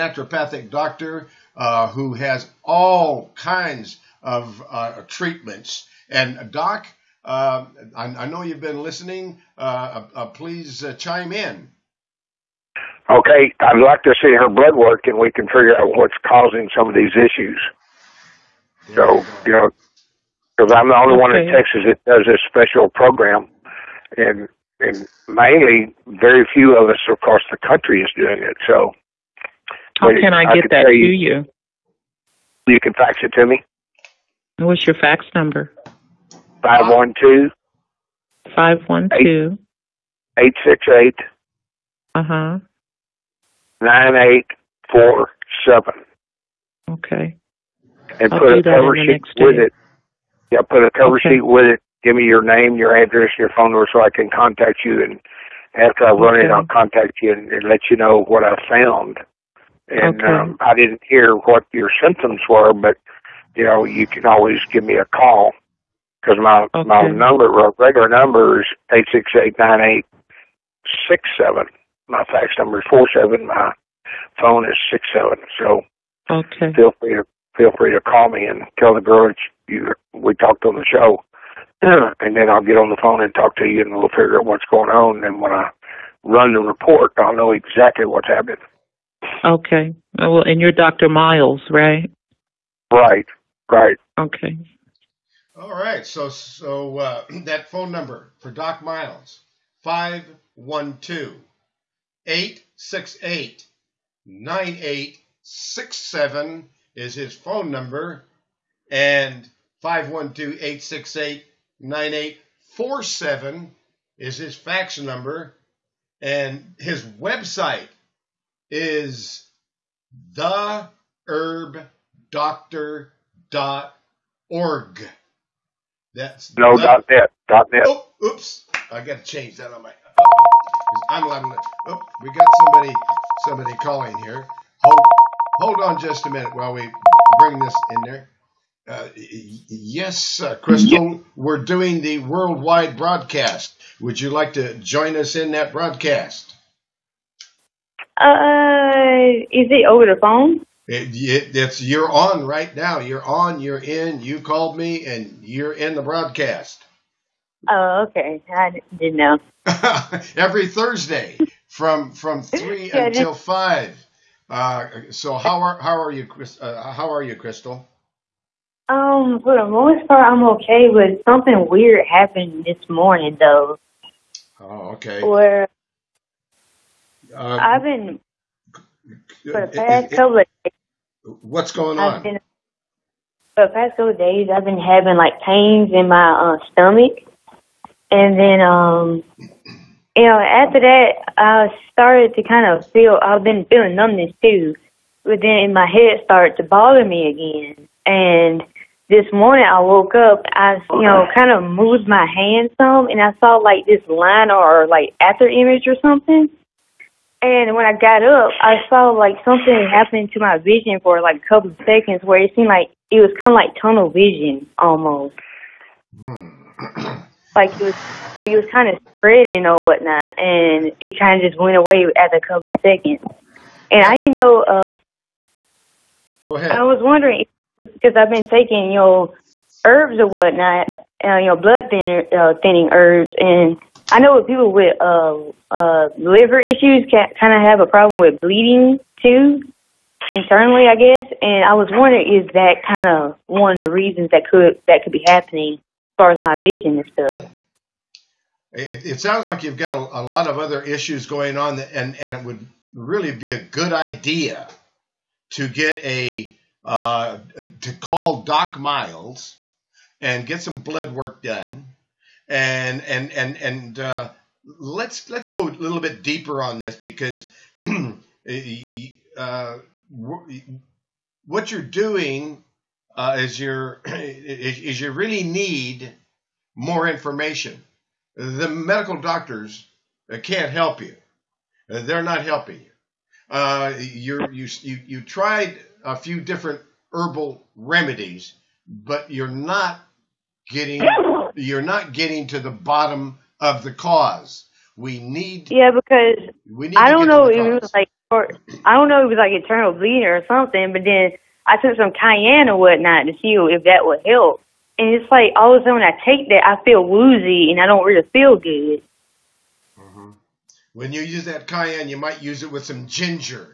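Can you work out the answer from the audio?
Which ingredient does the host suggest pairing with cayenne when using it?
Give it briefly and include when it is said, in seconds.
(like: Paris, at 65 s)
ginger, at 313 s.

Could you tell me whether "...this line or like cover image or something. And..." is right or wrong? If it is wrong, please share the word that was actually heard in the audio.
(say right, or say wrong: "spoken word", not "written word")
wrong: "after", not "cover".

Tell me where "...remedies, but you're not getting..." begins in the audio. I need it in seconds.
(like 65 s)
287 s.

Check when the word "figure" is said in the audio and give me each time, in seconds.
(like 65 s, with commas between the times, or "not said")
15 s, 84 s.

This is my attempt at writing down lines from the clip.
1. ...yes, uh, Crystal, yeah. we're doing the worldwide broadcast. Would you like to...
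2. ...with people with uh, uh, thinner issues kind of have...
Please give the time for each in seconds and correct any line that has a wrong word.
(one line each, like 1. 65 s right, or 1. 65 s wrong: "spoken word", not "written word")
1. 139 s right
2. 234 s wrong: "liver", not "thinner".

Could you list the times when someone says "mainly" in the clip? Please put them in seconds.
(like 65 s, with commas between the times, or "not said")
25 s.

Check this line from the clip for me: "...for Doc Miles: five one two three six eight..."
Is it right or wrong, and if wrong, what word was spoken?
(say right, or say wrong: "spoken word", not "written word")
wrong: "eight", not "three".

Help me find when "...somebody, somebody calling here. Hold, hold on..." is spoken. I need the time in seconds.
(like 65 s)
132 s.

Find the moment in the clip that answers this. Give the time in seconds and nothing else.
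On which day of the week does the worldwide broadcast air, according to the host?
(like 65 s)
160 s.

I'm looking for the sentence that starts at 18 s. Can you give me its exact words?
There so, you know, because I'm the only okay.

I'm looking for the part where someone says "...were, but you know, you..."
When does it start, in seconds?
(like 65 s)
62 s.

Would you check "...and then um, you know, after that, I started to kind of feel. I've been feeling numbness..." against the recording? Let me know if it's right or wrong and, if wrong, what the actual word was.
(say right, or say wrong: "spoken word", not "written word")
right.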